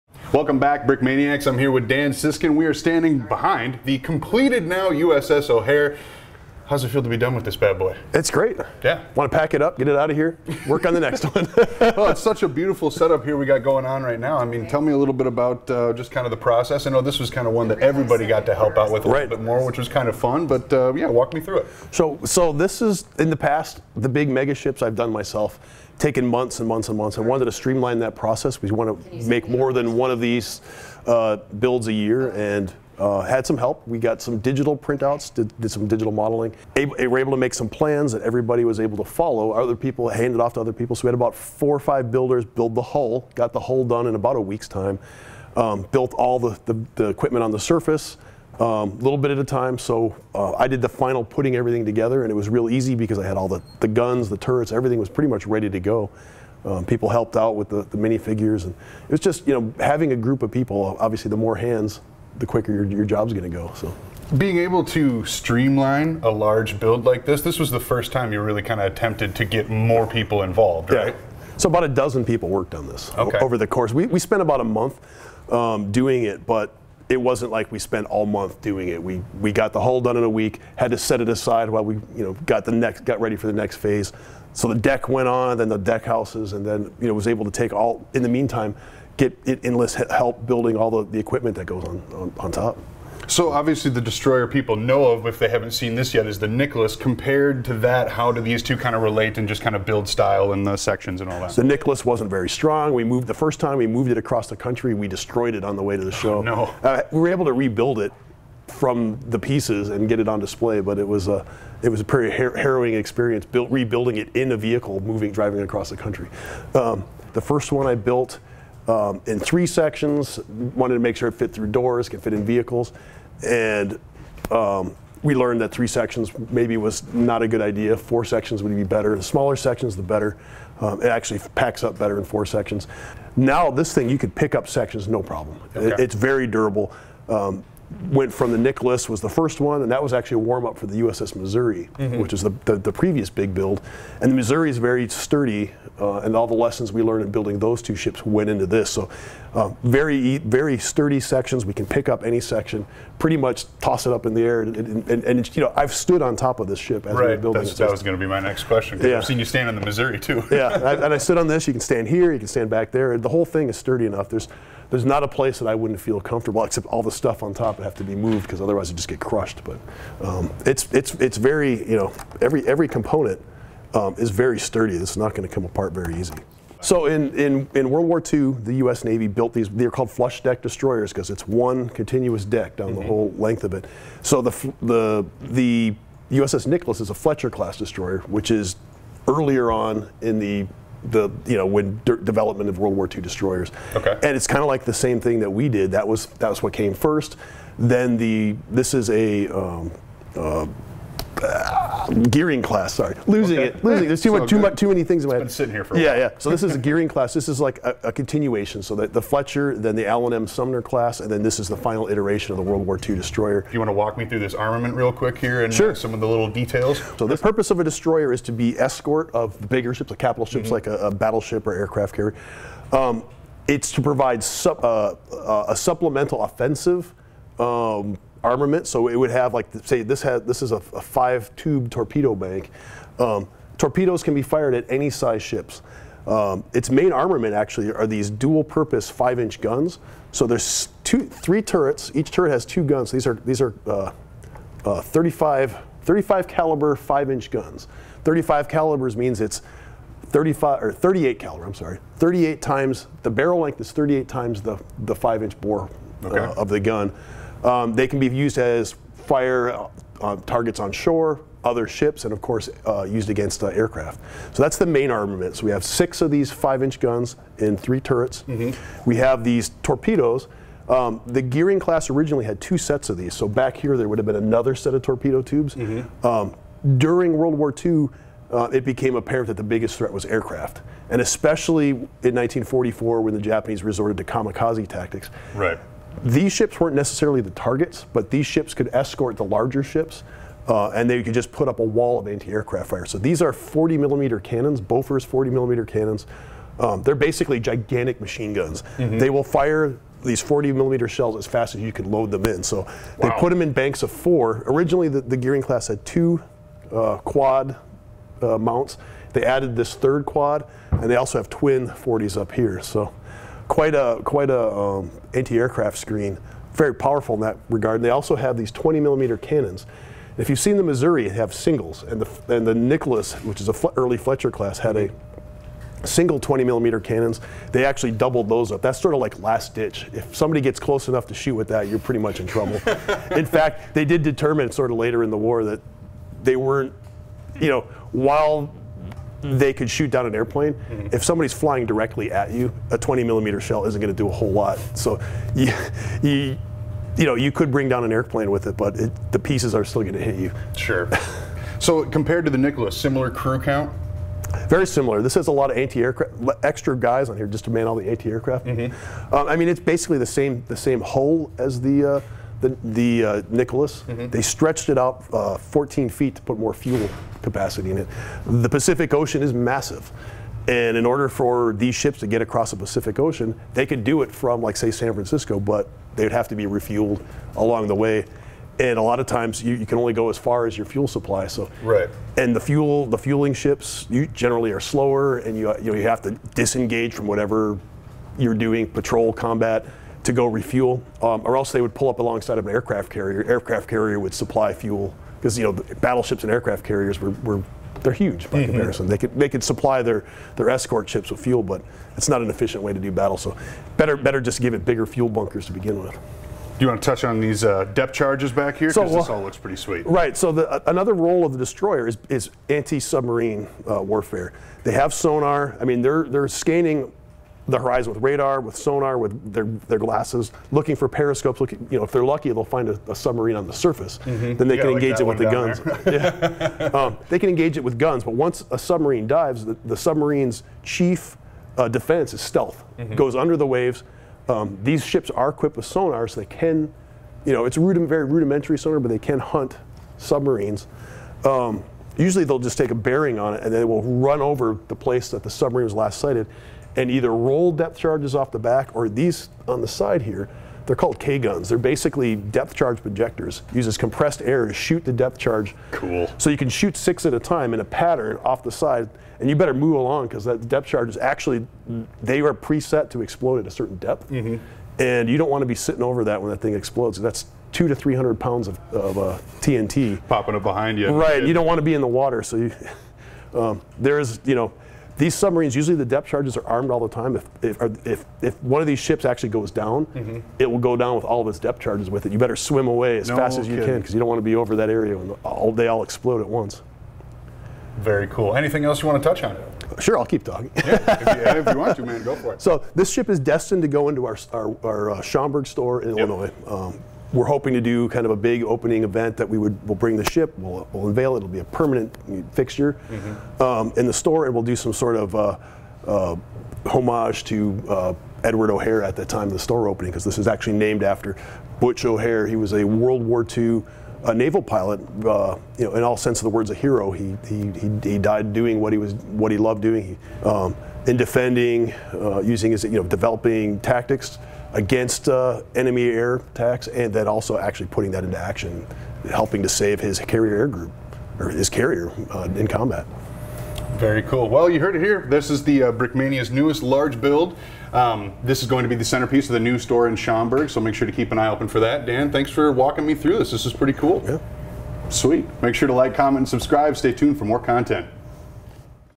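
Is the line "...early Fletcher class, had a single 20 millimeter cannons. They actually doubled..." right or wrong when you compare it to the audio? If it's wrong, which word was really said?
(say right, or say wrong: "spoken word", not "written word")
right.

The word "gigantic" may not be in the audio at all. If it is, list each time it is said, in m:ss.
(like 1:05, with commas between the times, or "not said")
4:57.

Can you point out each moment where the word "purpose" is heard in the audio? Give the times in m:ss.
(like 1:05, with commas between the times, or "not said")
3:37, 3:58.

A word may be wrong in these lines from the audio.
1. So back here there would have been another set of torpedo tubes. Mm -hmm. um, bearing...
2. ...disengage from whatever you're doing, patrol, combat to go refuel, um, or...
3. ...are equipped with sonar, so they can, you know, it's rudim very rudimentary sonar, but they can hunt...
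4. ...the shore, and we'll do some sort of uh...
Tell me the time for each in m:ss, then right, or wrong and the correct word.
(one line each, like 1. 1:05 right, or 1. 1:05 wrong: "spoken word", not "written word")
1. 4:33 wrong: "during", not "bearing"
2. 6:26 right
3. 7:15 right
4. 8:24 wrong: "store", not "shore".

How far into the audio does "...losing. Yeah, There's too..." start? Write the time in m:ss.
3:23.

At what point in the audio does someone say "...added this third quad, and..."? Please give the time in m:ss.
5:09.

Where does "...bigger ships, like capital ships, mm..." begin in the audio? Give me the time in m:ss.
3:39.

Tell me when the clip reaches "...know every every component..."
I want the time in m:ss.
2:51.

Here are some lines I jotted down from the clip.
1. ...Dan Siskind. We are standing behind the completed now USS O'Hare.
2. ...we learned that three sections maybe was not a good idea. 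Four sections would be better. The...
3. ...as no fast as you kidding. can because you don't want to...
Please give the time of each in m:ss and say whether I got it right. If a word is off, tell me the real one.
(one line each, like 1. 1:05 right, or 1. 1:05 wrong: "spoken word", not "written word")
1. 0:01 right
2. 2:05 right
3. 8:03 right.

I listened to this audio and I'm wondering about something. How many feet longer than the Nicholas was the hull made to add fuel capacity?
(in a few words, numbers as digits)
14.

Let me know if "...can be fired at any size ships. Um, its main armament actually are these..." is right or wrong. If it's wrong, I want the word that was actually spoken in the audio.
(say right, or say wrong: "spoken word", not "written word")
right.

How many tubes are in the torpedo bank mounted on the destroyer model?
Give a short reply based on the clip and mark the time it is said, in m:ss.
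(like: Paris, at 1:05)
5, at 3:51.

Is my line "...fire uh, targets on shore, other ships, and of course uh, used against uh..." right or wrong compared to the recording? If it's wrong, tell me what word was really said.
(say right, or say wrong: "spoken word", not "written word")
right.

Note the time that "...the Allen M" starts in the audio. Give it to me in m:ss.
3:29.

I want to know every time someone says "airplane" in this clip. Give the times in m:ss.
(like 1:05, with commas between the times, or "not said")
5:40, 5:48.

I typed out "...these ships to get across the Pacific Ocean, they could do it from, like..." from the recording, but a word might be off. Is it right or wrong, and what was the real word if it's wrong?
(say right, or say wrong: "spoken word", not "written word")
right.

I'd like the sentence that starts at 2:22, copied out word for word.
which is the, the, the, previous big build.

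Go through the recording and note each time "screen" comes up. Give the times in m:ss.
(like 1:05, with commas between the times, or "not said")
5:15.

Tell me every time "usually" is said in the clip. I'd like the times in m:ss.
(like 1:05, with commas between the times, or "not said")
7:22, 7:55.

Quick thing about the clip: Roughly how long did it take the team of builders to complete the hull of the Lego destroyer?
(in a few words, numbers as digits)
about a week.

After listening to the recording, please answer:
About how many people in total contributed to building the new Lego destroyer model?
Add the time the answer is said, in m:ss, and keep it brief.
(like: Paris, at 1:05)
about a dozen, at 1:11.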